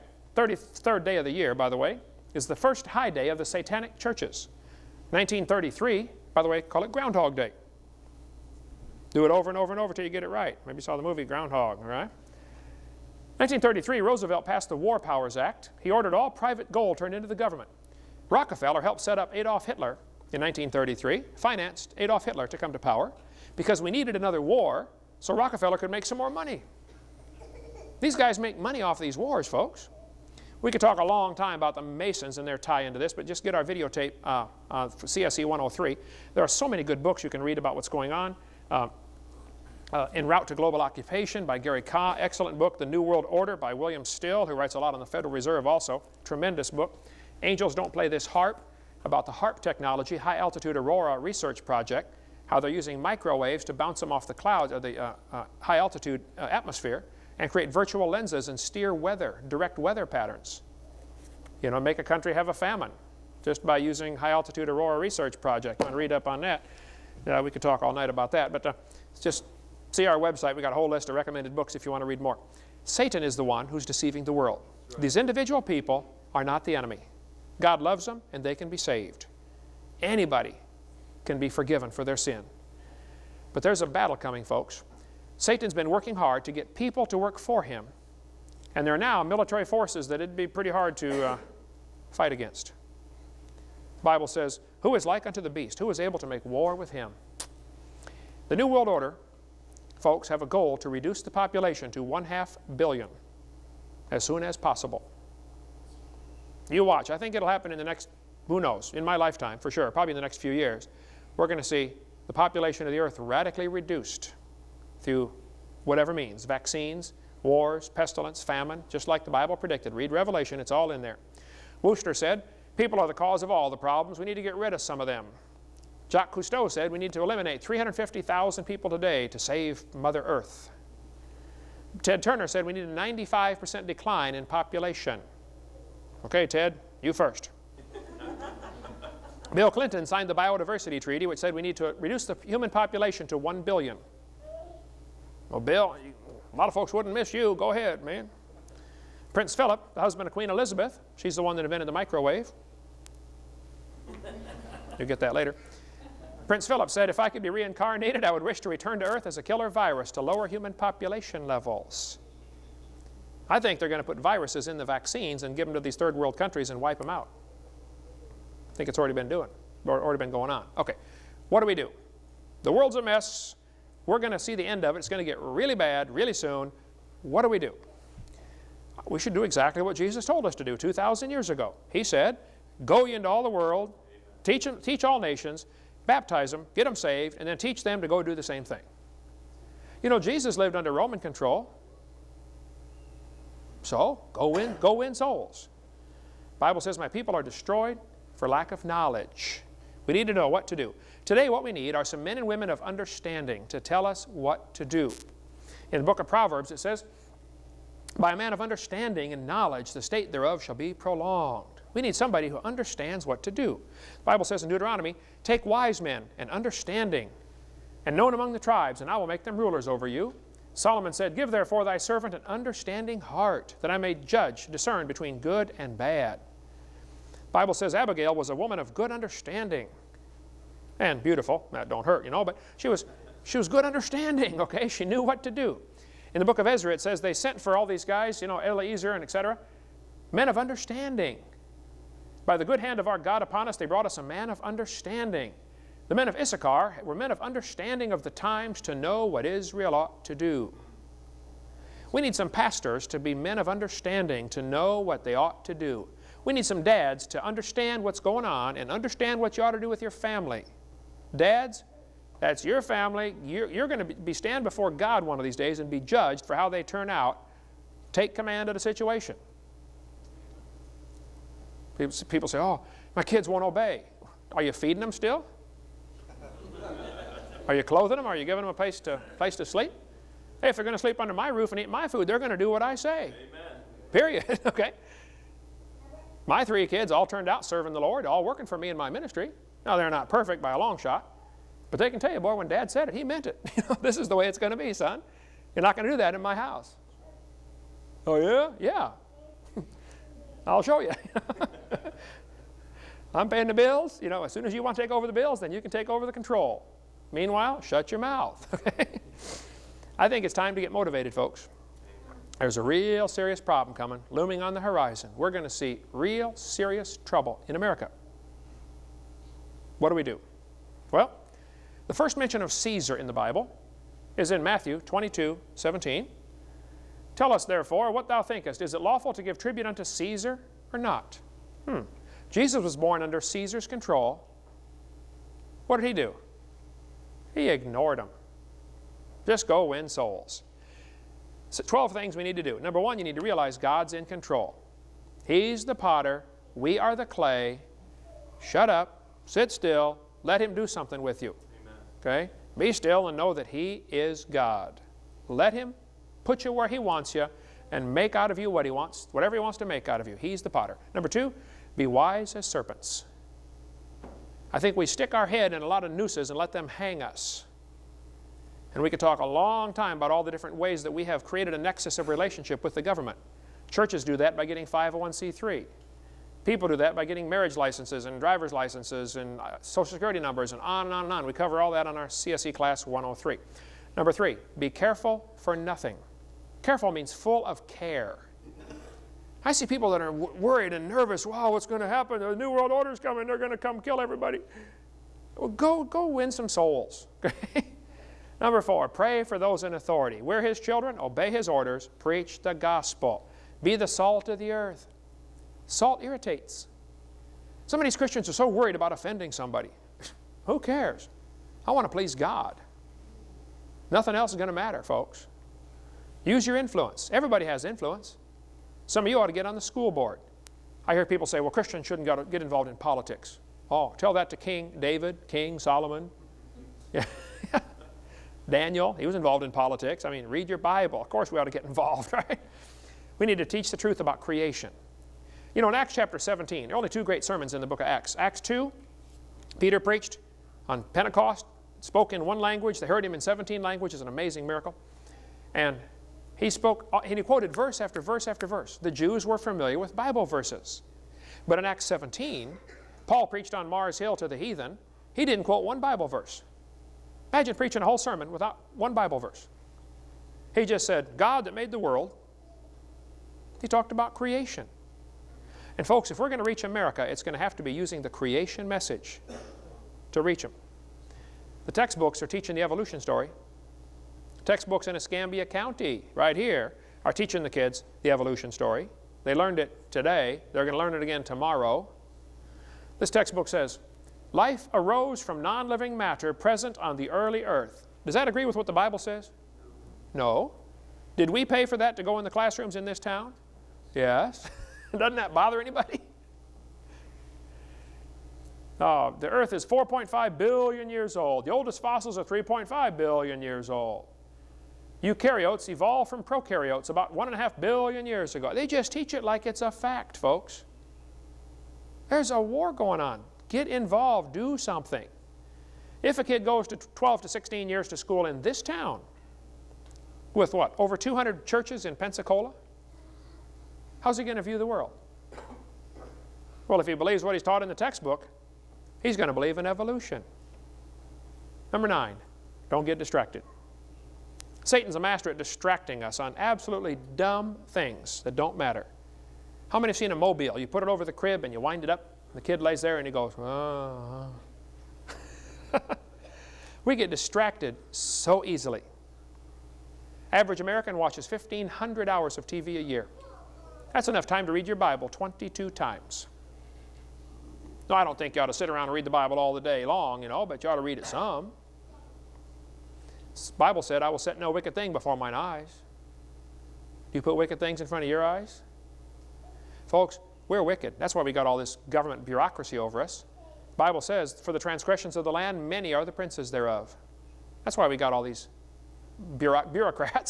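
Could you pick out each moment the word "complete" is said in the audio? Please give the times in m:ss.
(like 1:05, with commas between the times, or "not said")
not said.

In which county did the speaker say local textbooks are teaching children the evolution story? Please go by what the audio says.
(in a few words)
Escambia County.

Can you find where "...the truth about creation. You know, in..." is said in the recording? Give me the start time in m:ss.
7:13.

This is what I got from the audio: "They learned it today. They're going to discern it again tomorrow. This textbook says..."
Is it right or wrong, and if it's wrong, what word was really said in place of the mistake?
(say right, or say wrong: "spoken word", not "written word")
wrong: "learn", not "discern".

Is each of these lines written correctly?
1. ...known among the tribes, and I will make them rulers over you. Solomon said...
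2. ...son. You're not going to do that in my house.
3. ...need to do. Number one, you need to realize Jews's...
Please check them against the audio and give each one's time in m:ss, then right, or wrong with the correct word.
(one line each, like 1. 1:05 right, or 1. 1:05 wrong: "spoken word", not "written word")
1. 3:38 right
2. 4:54 right
3. 5:42 wrong: "God", not "Jews".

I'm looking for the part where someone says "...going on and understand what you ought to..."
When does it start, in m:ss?
4:18.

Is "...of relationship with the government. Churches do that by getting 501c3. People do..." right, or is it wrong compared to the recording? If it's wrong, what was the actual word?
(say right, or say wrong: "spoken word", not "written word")
right.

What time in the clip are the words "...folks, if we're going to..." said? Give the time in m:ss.
7:46.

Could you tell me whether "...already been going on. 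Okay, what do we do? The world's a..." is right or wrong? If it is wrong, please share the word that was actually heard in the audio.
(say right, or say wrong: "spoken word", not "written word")
right.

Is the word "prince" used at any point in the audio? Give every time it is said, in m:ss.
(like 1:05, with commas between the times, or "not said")
2:29, 2:36, 9:36.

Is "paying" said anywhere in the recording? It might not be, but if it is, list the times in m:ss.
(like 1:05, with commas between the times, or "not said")
5:03.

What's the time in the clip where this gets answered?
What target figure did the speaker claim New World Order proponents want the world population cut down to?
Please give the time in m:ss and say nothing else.
1:42.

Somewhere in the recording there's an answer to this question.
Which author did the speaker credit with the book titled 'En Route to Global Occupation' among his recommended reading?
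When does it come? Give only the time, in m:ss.
0:41.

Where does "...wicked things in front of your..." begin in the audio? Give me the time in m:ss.
9:27.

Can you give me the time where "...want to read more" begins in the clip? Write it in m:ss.
1:11.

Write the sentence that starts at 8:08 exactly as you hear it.
Does that agree with what the Bible says?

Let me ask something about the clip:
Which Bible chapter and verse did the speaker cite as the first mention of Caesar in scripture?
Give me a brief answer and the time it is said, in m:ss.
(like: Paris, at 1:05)
Matthew 22:17, at 5:24.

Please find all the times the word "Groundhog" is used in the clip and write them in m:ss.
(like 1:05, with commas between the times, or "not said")
0:06, 0:11.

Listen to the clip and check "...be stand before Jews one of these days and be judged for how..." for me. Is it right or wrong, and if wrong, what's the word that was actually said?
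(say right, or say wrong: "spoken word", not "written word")
wrong: "God", not "Jews".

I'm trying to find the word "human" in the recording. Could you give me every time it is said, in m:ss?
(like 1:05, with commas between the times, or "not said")
2:22, 2:40.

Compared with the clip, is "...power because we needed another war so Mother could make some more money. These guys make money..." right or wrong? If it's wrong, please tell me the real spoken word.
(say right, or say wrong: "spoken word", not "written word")
wrong: "Rockefeller", not "Mother".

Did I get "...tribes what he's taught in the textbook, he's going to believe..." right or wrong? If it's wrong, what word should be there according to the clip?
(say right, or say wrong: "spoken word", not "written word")
wrong: "believes", not "tribes".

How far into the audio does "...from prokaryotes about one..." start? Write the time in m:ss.
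8:26.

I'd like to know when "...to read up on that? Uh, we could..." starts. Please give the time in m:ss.
1:05.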